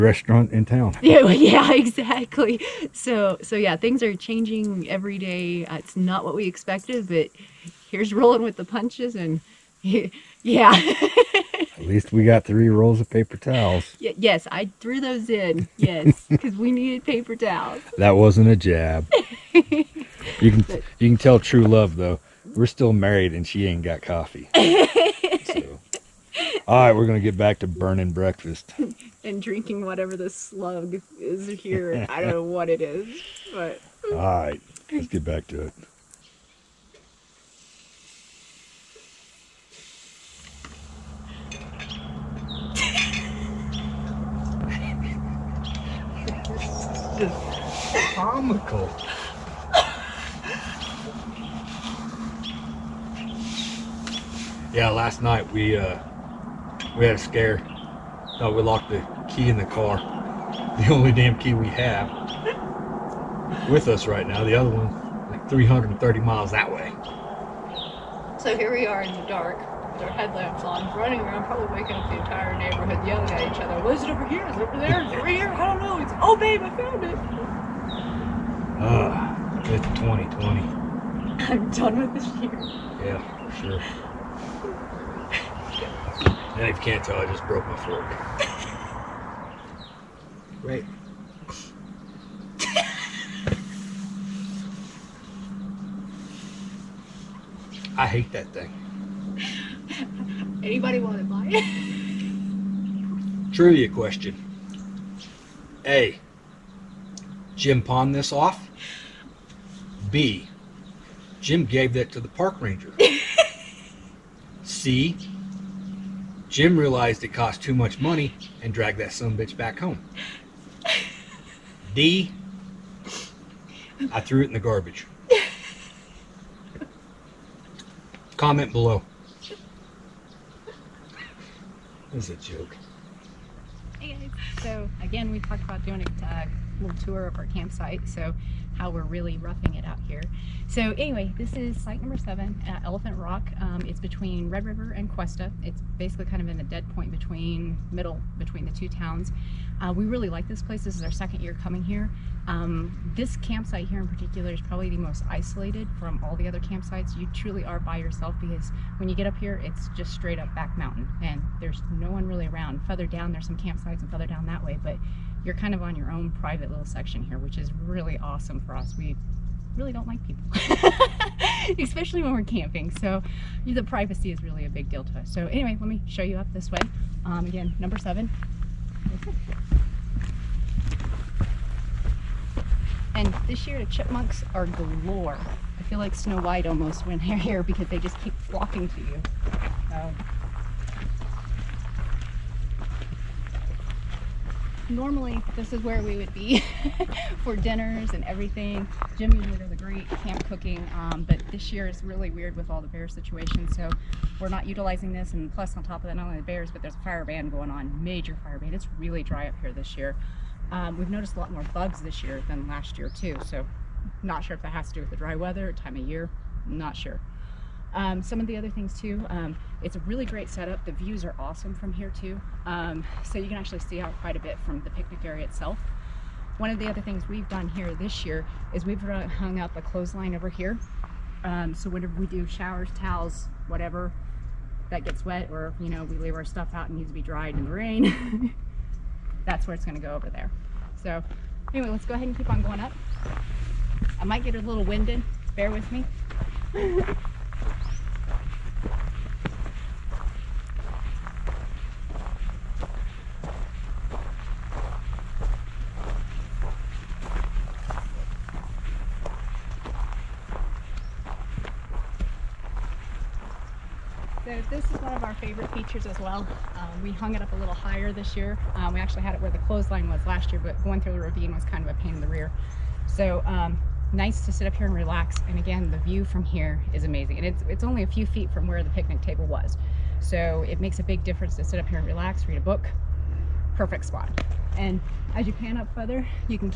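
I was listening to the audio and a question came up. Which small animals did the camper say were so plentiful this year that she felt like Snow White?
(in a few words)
Chipmunks.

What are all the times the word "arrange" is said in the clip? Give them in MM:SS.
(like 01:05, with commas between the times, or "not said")
not said.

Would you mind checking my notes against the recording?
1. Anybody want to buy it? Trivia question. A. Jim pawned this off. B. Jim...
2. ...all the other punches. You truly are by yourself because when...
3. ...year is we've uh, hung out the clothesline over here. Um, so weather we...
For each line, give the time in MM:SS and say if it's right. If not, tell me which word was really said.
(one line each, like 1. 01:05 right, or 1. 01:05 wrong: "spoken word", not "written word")
1. 01:40 right
2. 02:36 wrong: "campsites", not "punches"
3. 03:48 wrong: "whenever", not "weather".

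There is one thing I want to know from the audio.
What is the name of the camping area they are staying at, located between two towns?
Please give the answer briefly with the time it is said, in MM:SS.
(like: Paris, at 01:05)
Elephant Rock, at 02:22.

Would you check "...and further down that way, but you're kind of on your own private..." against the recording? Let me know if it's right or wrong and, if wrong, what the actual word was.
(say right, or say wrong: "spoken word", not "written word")
right.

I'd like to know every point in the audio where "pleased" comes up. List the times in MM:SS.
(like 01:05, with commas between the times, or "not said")
not said.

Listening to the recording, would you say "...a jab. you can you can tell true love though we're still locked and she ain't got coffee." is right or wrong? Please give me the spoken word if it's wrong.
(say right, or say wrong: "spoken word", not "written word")
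wrong: "married", not "locked".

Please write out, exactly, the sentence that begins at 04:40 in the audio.
So it makes a big difference to sit up here and relax, read a book.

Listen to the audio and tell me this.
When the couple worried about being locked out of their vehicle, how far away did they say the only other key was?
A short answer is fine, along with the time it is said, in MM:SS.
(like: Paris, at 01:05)
330 miles, at 01:05.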